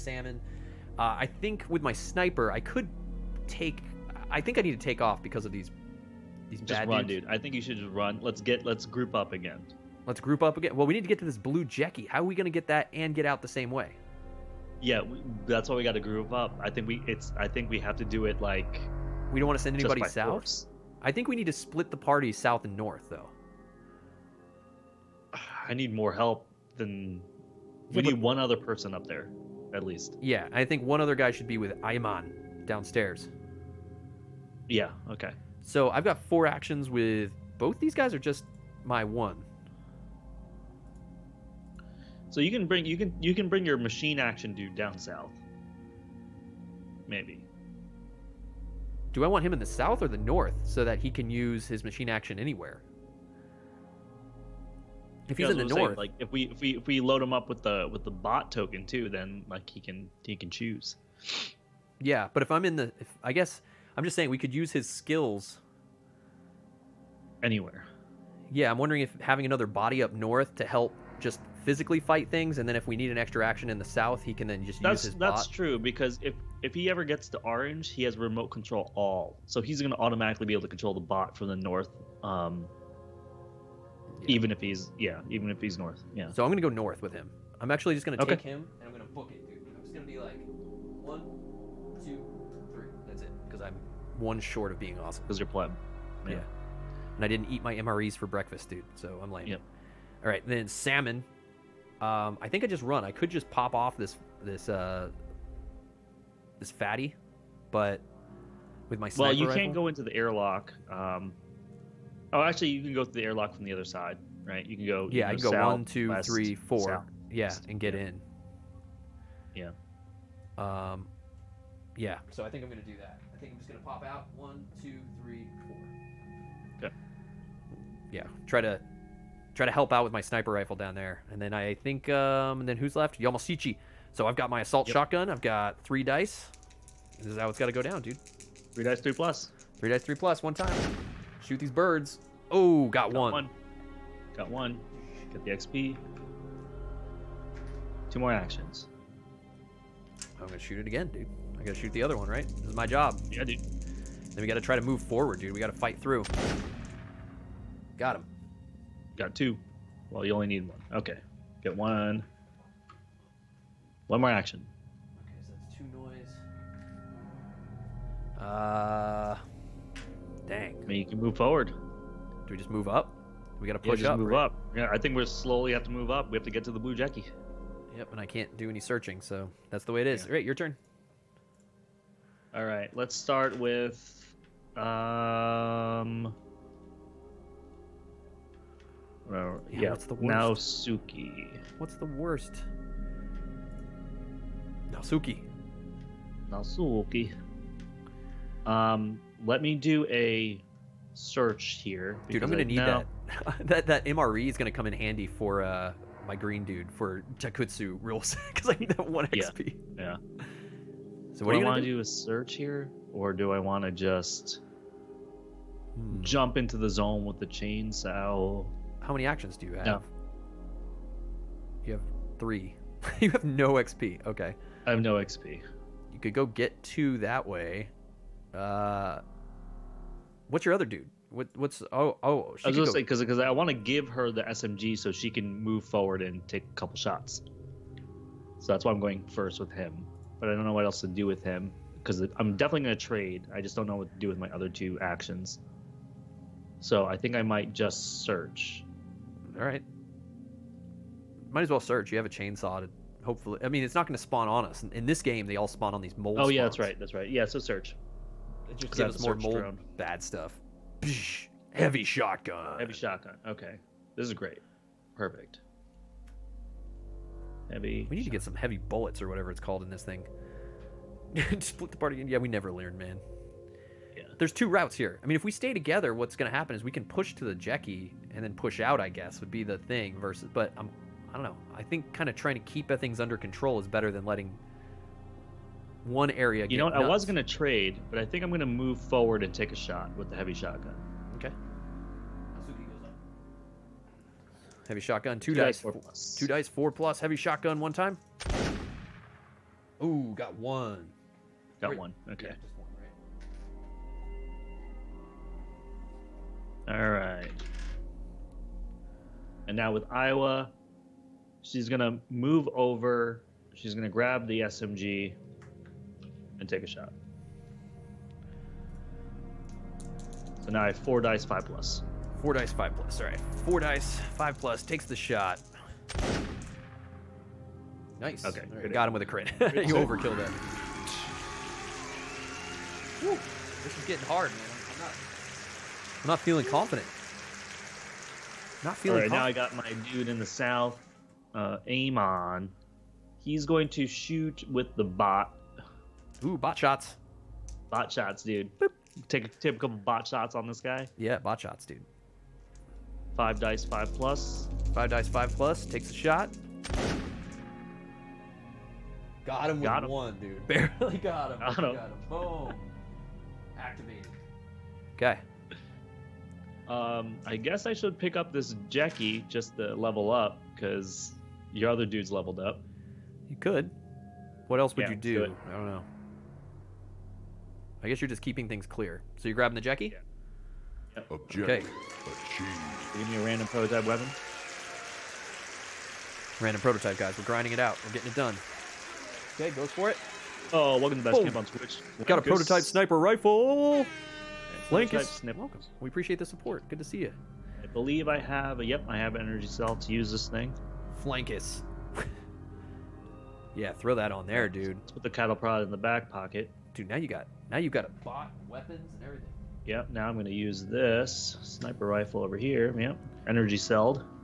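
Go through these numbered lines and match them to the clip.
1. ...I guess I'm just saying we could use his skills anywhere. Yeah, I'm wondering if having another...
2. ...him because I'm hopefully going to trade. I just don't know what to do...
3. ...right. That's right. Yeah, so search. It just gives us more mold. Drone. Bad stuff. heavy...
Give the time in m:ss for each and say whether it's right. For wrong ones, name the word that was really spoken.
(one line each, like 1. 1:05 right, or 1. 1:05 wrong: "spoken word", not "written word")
1. 1:03 right
2. 4:01 wrong: "definitely", not "hopefully"
3. 4:16 right.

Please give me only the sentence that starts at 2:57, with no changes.
Yep, and I can't do any searching, so that's the way it is.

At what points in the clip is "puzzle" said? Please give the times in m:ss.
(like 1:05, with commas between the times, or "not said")
not said.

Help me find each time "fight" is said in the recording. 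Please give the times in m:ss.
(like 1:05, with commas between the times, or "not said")
1:12, 2:35.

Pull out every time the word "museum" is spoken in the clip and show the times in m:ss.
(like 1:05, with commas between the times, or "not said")
not said.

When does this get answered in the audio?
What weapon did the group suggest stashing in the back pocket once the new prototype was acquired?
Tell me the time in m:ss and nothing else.
6:45.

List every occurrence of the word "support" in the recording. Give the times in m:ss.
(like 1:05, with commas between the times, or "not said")
6:36.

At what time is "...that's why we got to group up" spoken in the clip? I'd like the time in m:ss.
0:15.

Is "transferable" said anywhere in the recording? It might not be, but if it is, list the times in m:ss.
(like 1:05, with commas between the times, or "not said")
not said.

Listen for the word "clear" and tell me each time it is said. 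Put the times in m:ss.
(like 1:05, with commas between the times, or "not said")
6:18.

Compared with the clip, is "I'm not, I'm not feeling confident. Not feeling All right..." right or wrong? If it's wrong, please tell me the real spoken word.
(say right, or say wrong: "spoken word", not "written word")
right.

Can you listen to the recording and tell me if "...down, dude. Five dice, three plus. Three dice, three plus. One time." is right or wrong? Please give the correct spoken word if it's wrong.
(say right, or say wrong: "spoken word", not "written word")
wrong: "Three", not "Five".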